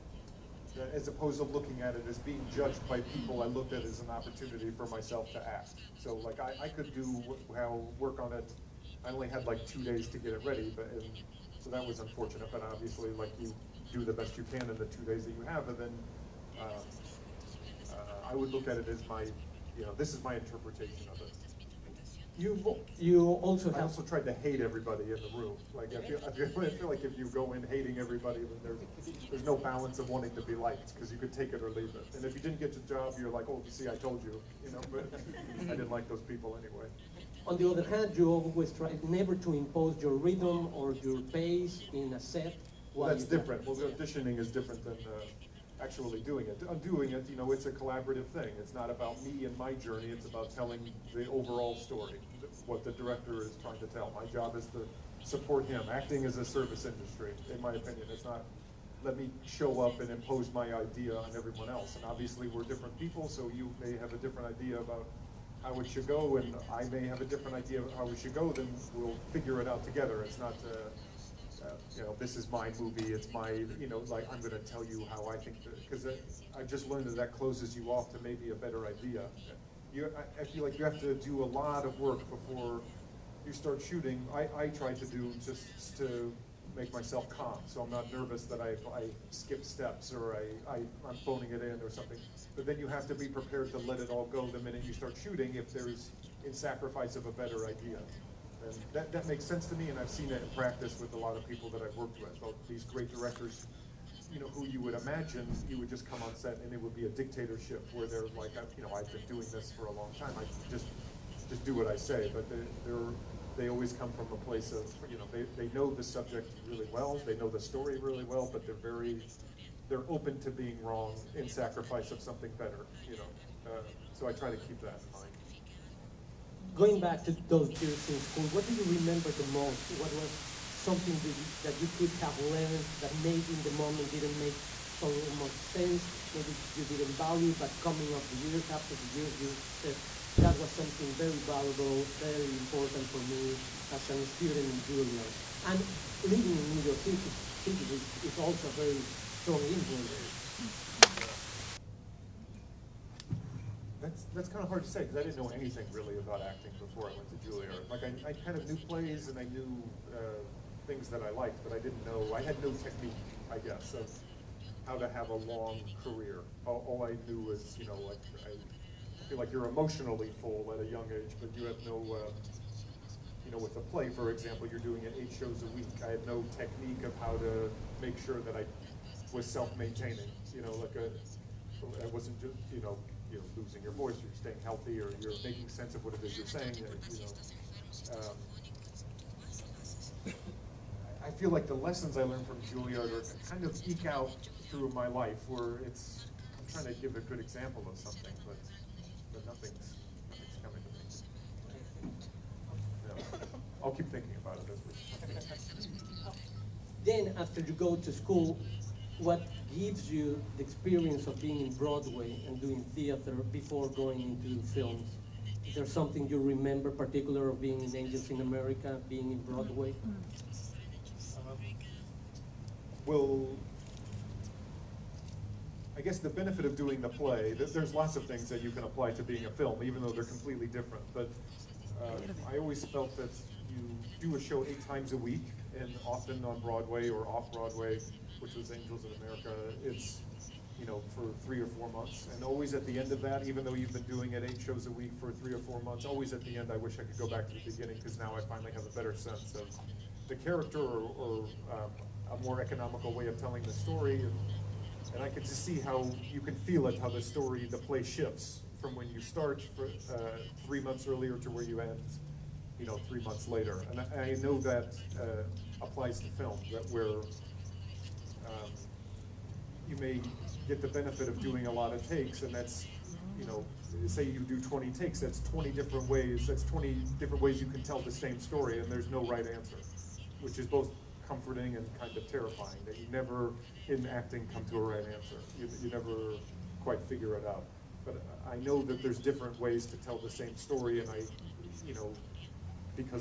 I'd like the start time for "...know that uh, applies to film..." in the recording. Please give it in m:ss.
4:24.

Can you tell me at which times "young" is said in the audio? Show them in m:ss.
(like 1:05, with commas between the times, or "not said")
2:50.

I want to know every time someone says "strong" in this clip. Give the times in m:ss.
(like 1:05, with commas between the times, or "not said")
2:29.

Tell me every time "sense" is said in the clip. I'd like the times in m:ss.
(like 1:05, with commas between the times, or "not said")
1:39, 2:15, 3:05, 4:09.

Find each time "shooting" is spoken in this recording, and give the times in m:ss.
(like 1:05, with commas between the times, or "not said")
1:23, 1:35.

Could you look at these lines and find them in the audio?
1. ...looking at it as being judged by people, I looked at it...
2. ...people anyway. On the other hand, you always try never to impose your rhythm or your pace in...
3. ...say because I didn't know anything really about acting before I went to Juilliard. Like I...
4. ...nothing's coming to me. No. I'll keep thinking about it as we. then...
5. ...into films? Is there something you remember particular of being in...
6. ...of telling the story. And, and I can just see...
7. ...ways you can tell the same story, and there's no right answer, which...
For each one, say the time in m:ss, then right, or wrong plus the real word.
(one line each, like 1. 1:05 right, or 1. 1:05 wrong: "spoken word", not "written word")
1. 0:01 right
2. 0:36 right
3. 2:34 right
4. 3:20 right
5. 3:34 right
6. 4:13 right
7. 4:37 right.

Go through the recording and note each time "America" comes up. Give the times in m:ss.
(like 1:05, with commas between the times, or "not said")
3:38, 3:59.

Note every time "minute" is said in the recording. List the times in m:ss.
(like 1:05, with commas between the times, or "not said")
1:34.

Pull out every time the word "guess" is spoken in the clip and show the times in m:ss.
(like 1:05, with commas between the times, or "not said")
2:43, 3:46.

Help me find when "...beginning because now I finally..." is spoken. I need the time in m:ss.
4:07.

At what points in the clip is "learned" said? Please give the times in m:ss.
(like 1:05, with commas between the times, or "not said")
1:16, 2:12, 3:12.